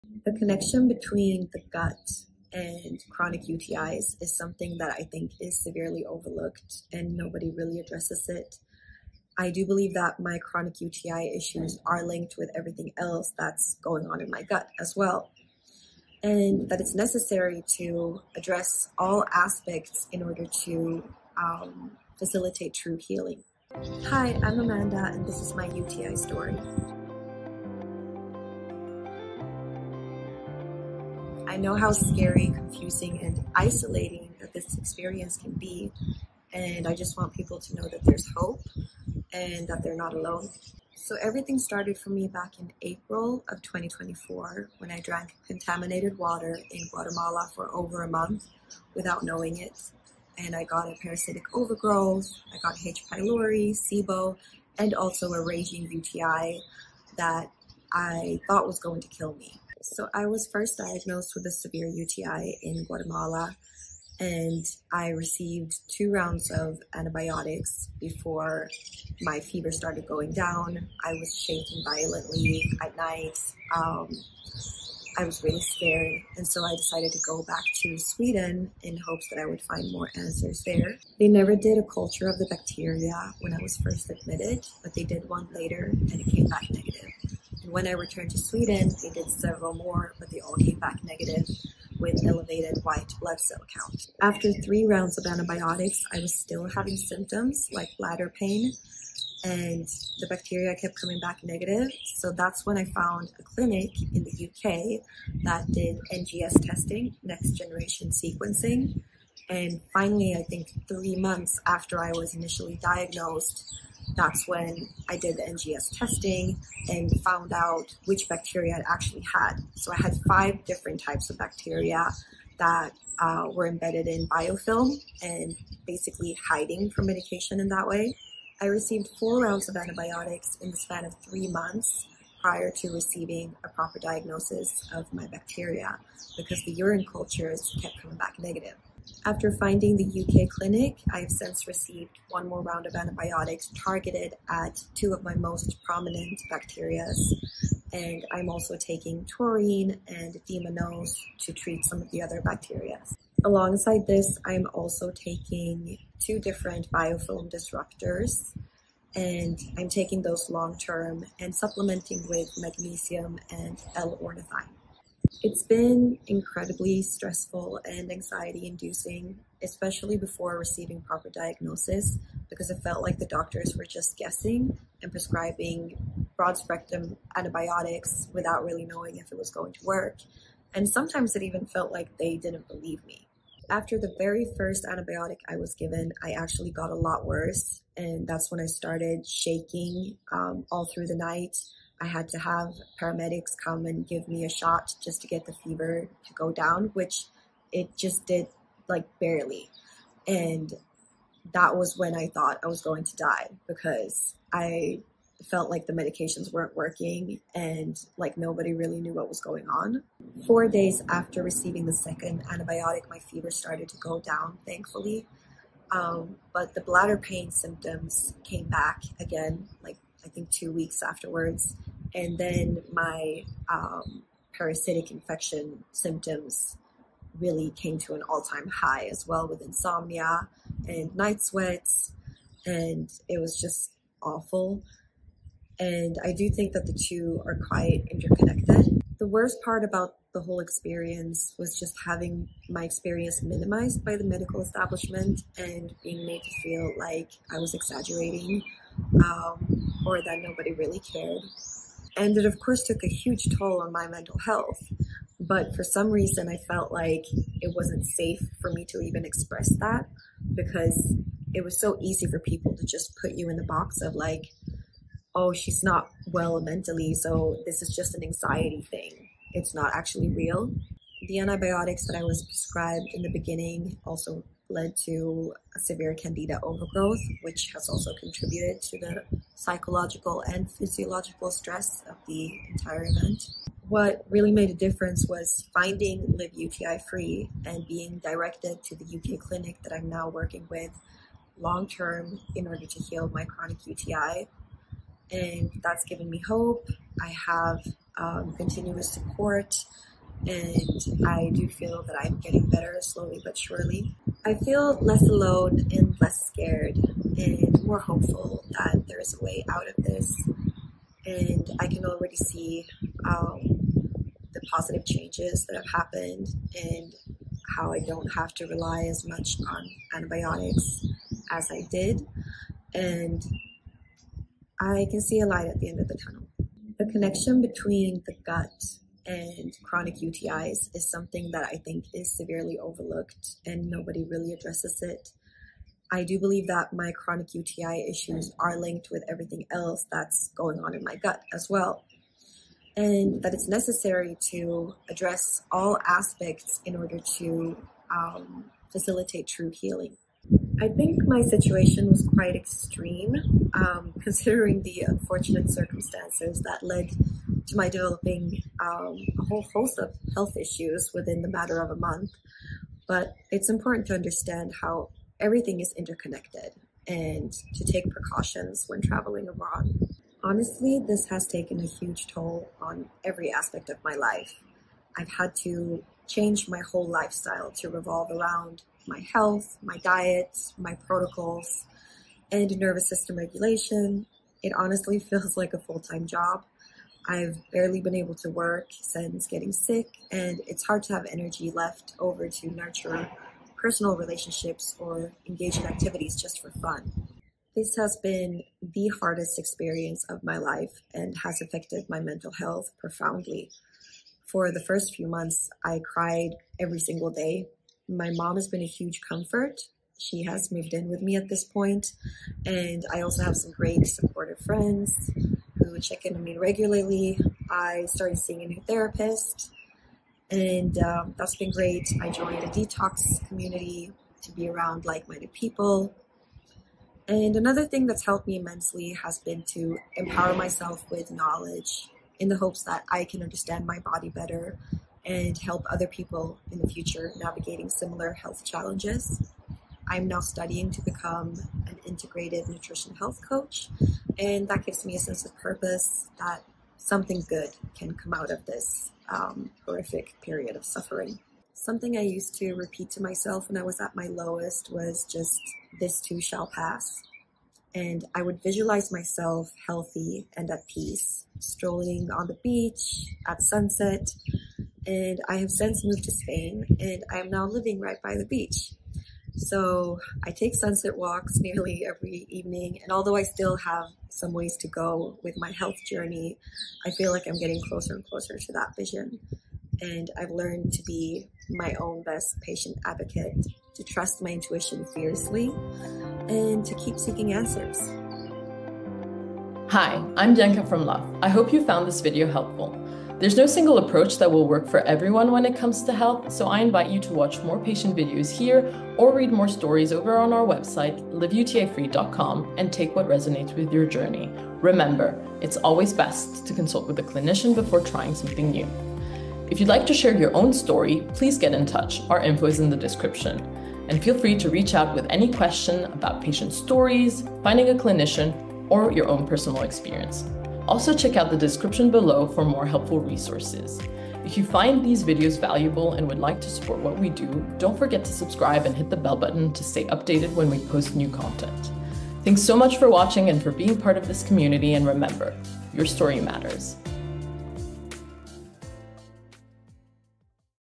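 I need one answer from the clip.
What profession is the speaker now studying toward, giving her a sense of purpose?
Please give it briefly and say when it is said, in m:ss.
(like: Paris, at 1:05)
Integrated nutrition health coach, at 7:22.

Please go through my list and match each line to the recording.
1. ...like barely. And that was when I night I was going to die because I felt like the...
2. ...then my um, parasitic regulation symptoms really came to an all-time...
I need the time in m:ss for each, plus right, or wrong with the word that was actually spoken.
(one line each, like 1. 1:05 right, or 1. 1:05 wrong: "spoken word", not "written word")
1. 3:18 wrong: "thought", not "night"
2. 3:42 wrong: "infection", not "regulation".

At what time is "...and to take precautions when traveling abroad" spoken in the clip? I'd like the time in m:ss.
6:07.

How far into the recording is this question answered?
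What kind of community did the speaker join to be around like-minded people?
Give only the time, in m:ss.
7:02.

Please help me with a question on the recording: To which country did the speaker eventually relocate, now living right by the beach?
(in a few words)
Spain.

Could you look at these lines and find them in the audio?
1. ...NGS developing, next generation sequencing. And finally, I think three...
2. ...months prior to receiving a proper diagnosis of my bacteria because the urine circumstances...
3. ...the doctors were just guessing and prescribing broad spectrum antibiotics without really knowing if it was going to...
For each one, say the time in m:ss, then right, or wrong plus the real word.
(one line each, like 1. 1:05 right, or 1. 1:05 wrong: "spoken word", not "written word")
1. 1:46 wrong: "testing", not "developing"
2. 2:11 wrong: "cultures", not "circumstances"
3. 2:53 right.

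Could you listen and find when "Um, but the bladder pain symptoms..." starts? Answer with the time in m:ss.
3:35.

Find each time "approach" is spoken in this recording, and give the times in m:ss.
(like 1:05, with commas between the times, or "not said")
8:13.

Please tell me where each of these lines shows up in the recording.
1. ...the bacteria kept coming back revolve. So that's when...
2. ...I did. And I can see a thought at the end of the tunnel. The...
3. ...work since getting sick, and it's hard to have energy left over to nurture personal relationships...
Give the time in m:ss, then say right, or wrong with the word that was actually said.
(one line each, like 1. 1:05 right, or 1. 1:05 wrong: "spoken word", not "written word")
1. 1:40 wrong: "negative", not "revolve"
2. 5:21 wrong: "light", not "thought"
3. 6:28 right.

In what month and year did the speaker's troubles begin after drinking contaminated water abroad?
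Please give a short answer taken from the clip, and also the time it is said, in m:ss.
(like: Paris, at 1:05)
April 2024, at 0:42.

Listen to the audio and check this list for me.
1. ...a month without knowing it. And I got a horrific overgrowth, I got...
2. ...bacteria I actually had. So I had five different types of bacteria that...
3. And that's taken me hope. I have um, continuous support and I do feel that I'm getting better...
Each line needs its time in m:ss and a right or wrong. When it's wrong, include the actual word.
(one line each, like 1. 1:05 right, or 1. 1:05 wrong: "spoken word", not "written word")
1. 0:48 wrong: "parasitic", not "horrific"
2. 1:58 right
3. 4:55 wrong: "given", not "taken".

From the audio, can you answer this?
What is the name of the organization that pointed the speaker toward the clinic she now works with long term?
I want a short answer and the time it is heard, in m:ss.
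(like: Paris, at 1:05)
Live UTI Free, at 4:46.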